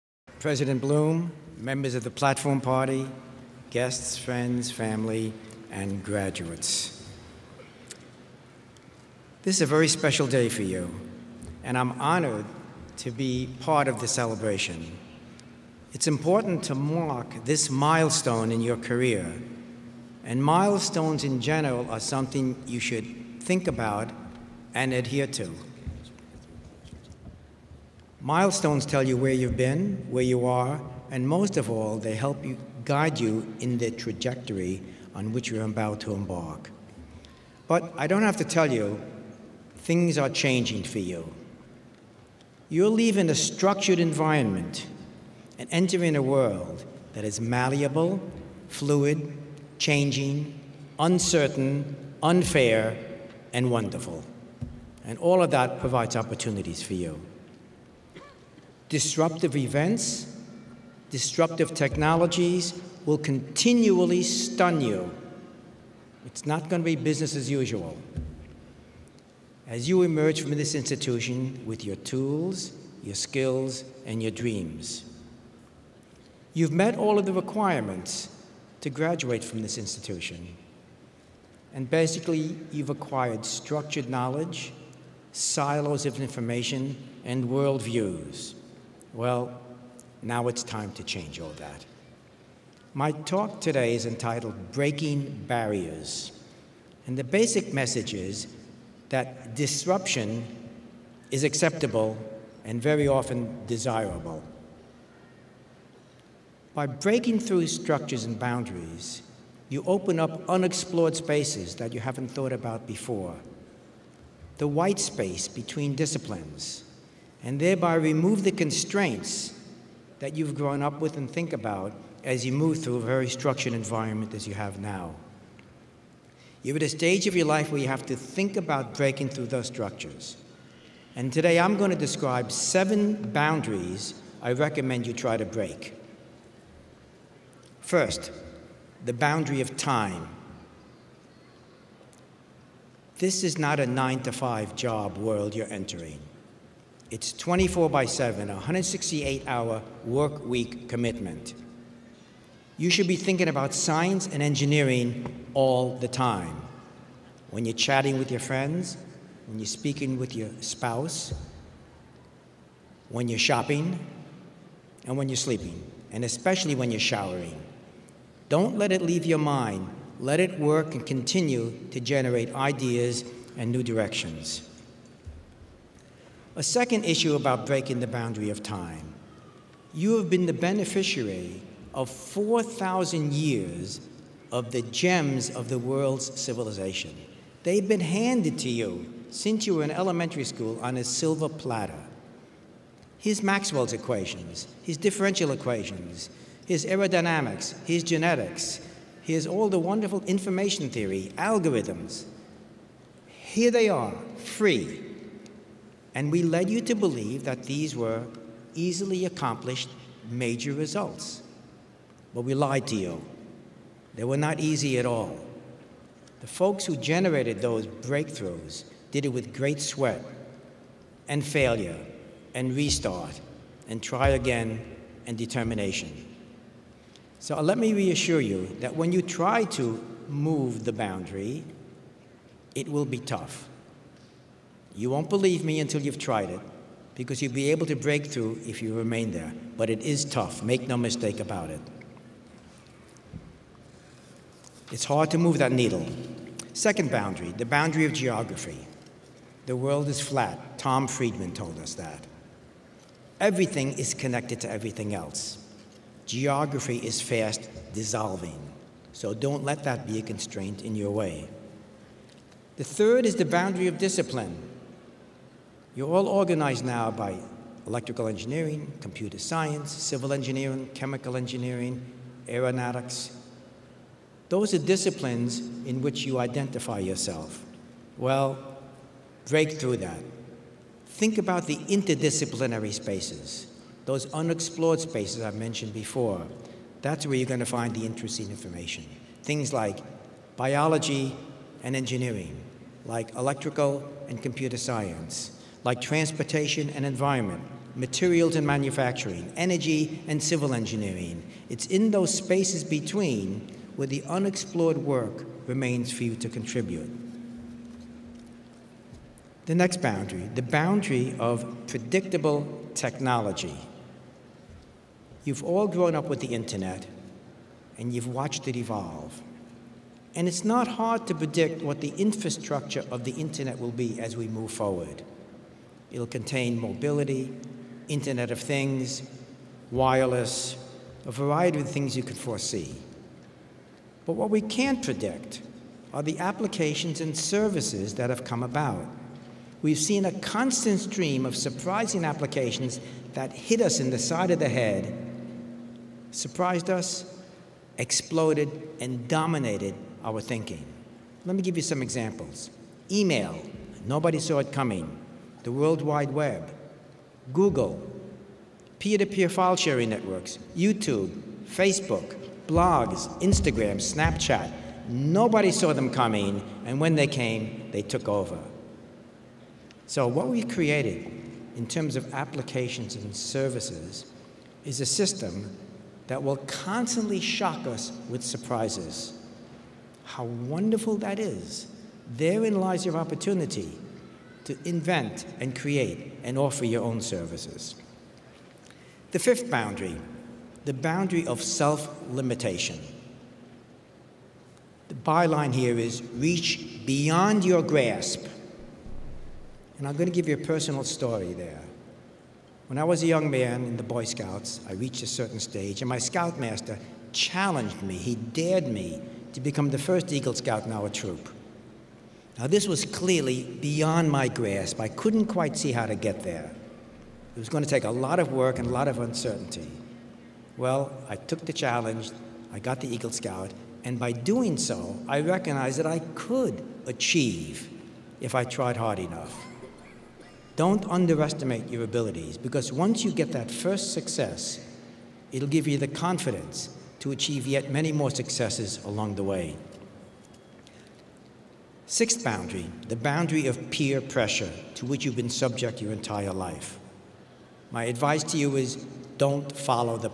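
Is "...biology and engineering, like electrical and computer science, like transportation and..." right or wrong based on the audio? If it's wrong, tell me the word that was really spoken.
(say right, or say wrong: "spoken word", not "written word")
right.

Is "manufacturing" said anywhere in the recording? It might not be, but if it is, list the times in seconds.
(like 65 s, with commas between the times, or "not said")
298 s.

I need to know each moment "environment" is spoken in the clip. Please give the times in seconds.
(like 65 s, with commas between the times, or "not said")
43 s, 123 s, 297 s.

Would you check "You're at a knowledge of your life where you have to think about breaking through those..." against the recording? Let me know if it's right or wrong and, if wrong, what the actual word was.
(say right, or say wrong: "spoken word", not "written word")
wrong: "stage", not "knowledge".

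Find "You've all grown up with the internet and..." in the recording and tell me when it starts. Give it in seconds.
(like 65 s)
315 s.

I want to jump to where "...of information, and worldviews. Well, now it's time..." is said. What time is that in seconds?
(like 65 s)
86 s.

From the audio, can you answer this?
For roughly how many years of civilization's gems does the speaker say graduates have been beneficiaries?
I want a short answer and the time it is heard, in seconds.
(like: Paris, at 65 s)
4,000, at 182 s.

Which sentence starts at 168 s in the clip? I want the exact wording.
Don't let it leave your mind.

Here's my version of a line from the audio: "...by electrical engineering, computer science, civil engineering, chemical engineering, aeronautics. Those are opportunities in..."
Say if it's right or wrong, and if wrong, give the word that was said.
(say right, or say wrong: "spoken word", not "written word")
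wrong: "disciplines", not "opportunities".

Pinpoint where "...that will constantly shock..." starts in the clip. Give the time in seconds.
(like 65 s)
376 s.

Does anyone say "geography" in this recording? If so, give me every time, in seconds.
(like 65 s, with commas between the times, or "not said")
248 s, 256 s.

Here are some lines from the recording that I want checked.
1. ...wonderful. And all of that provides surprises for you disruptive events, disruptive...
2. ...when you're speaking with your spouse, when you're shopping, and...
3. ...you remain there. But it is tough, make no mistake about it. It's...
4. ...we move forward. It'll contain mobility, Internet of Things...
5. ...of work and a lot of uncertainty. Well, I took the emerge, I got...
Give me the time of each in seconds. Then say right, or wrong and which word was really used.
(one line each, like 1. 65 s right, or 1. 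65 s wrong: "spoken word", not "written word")
1. 53 s wrong: "opportunities", not "surprises"
2. 159 s right
3. 238 s right
4. 324 s right
5. 418 s wrong: "challenge", not "emerge".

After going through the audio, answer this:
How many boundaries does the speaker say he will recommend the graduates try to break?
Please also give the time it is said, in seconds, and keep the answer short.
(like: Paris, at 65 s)
7, at 132 s.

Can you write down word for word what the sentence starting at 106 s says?
By breaking through structures and boundaries, you open up unexplored spaces that you haven't thought about before.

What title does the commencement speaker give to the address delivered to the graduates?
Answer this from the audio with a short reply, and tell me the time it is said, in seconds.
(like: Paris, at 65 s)
Breaking Barriers, at 94 s.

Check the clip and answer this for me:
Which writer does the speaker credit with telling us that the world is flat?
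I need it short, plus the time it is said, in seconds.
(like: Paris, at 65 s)
Tom Friedman, at 250 s.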